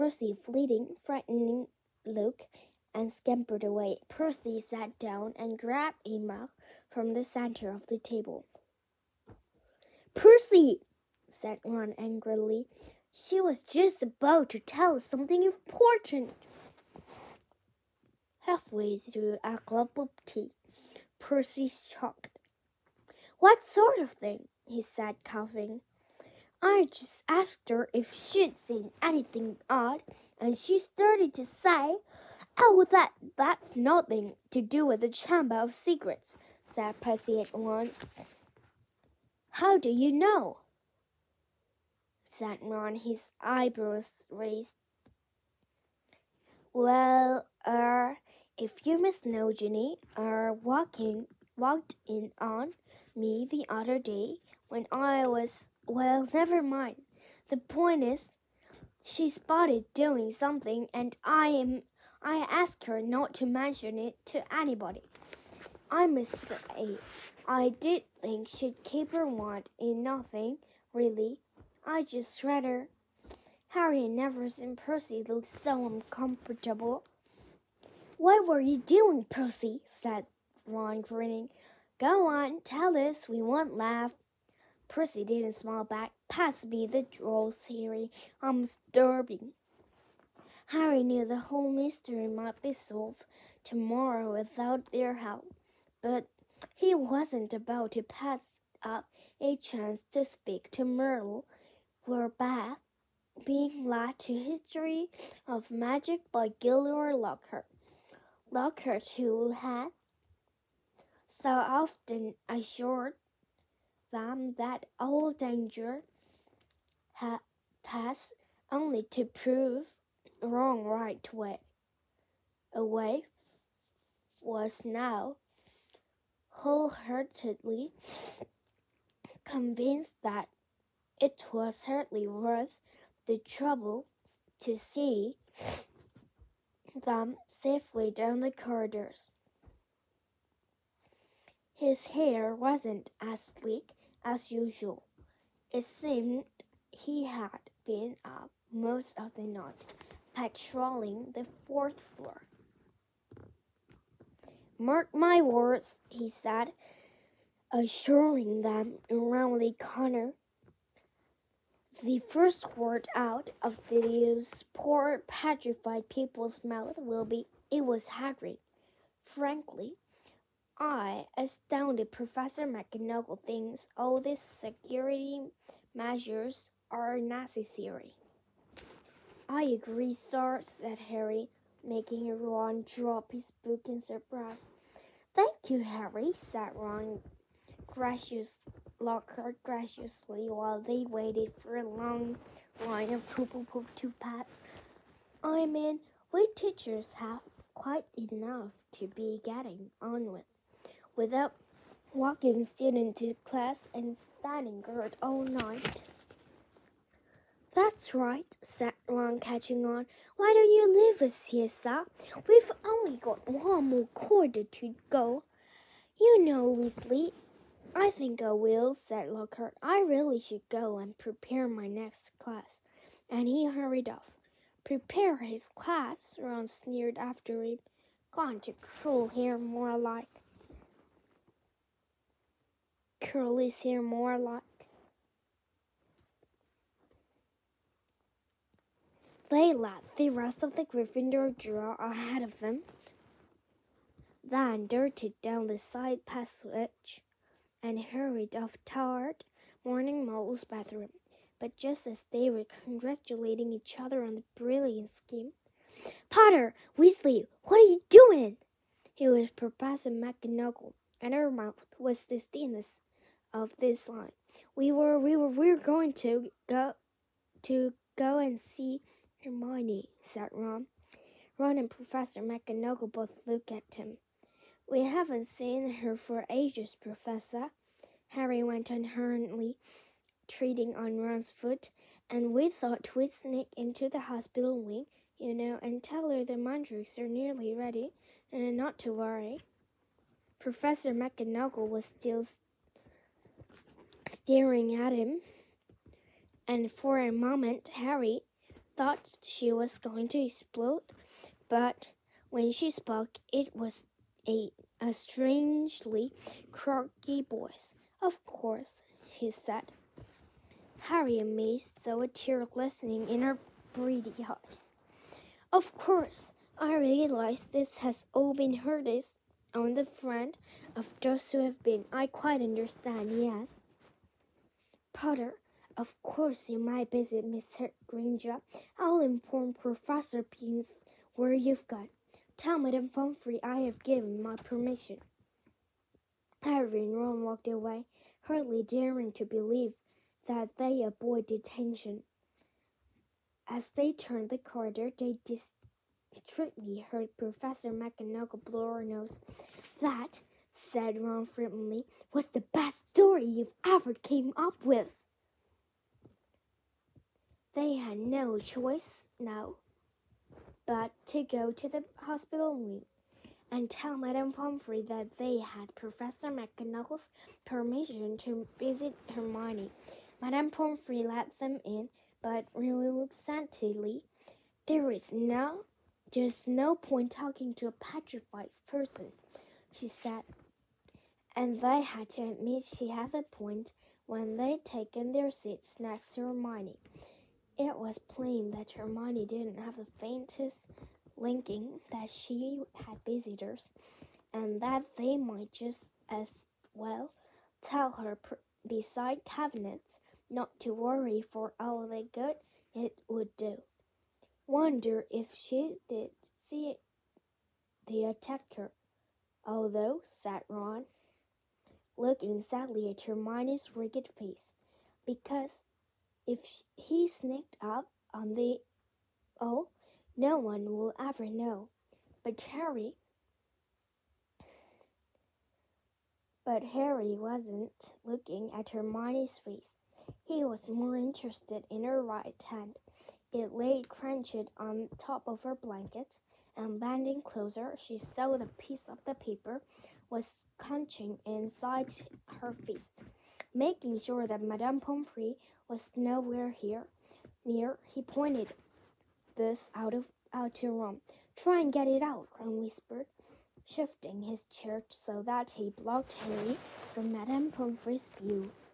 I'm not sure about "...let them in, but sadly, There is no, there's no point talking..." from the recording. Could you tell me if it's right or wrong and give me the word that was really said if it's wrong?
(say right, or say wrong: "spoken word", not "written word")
right.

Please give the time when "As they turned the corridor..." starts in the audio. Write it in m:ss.
5:43.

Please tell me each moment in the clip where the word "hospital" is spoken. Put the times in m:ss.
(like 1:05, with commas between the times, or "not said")
4:44, 6:02.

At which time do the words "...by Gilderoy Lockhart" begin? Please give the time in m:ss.
1:46.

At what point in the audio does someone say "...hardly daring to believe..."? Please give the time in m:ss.
5:38.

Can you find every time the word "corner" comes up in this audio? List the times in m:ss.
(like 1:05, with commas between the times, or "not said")
2:39.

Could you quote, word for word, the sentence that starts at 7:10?
He was more interested in her right hand.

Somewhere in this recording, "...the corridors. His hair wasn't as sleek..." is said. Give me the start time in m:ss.
2:18.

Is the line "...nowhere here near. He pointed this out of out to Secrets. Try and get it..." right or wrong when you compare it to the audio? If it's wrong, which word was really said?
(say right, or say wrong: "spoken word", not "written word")
wrong: "Ron", not "Secrets".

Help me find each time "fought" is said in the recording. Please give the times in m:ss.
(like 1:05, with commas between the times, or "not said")
not said.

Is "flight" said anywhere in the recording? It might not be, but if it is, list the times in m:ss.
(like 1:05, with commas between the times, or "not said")
not said.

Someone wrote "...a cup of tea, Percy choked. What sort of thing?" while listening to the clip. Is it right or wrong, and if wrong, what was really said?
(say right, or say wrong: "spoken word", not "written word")
right.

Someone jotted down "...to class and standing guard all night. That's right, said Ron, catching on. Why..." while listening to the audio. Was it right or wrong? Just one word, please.
right.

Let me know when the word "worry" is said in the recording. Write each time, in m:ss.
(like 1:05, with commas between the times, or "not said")
4:49, 6:40.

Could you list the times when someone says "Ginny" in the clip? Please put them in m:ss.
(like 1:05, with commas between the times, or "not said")
0:49.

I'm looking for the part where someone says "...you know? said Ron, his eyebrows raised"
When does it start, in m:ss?
0:39.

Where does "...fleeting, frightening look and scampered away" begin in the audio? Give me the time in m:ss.
0:00.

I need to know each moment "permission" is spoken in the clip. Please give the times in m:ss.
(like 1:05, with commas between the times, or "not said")
5:34, 6:07.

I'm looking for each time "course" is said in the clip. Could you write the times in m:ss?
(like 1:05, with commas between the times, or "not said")
5:08, 5:15, 5:26.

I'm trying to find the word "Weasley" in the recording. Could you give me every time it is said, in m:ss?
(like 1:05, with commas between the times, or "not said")
3:36, 4:16.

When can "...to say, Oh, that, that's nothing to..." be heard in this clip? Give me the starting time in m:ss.
0:31.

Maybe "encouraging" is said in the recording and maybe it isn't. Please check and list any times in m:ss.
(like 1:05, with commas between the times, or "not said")
not said.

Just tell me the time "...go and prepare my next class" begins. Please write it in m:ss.
3:40.